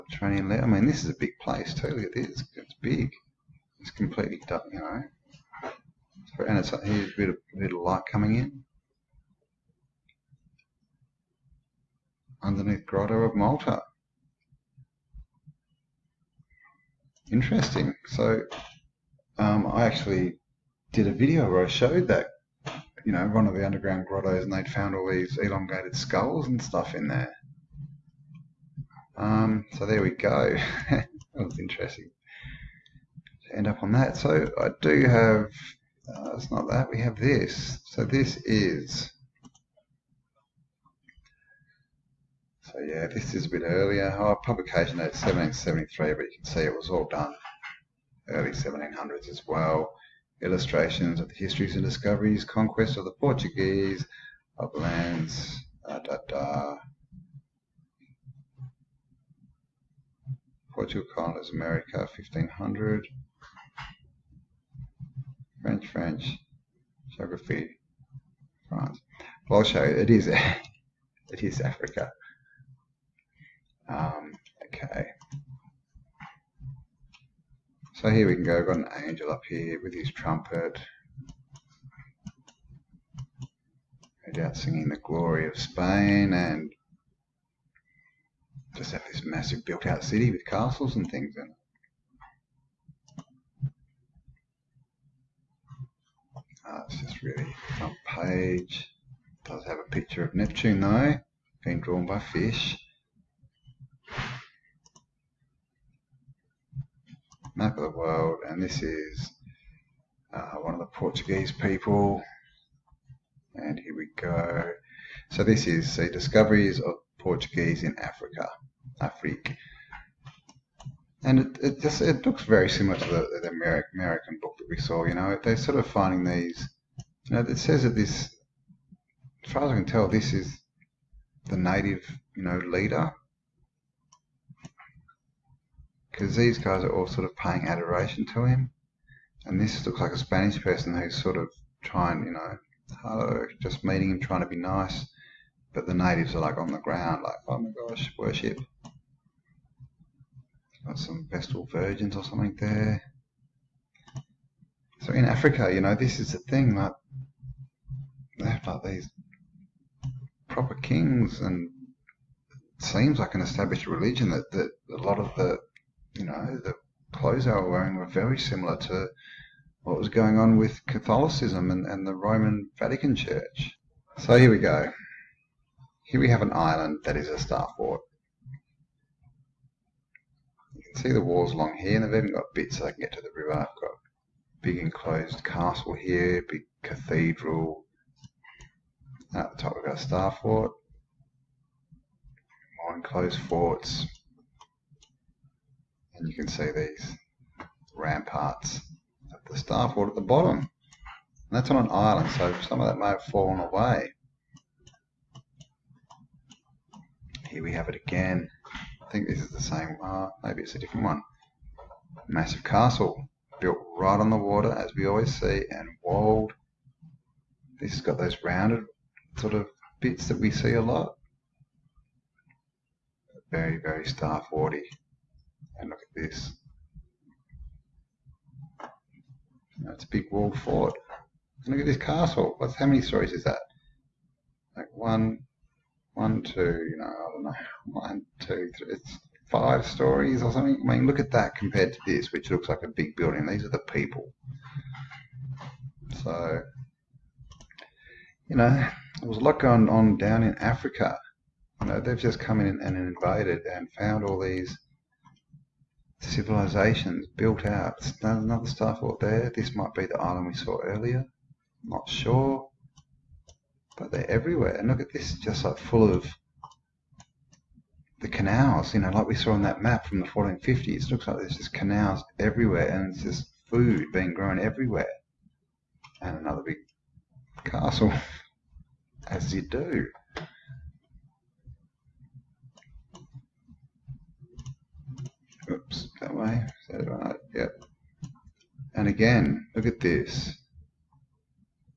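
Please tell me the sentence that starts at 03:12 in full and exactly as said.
More enclosed forts and you can see these ramparts at the star fort at the bottom.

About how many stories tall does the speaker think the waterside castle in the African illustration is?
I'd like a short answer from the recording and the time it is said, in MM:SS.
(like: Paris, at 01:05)
5, at 03:59.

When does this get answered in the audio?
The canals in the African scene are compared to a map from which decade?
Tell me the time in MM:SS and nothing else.
04:30.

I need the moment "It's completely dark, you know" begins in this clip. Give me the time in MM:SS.
00:03.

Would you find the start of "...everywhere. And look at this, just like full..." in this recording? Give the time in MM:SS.
04:24.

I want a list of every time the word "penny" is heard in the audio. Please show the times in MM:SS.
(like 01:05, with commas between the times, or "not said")
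not said.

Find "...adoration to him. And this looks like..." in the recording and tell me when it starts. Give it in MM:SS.
02:17.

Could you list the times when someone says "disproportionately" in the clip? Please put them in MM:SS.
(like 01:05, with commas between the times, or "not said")
not said.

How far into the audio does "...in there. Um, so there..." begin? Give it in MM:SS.
00:26.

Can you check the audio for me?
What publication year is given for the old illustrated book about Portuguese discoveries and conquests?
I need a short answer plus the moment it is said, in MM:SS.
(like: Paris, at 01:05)
1773, at 00:45.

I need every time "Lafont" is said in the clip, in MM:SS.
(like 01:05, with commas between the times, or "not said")
not said.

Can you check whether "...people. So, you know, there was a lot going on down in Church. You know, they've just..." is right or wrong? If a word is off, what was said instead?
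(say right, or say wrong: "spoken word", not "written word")
wrong: "Africa", not "Church".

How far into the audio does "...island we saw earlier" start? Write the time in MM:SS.
04:20.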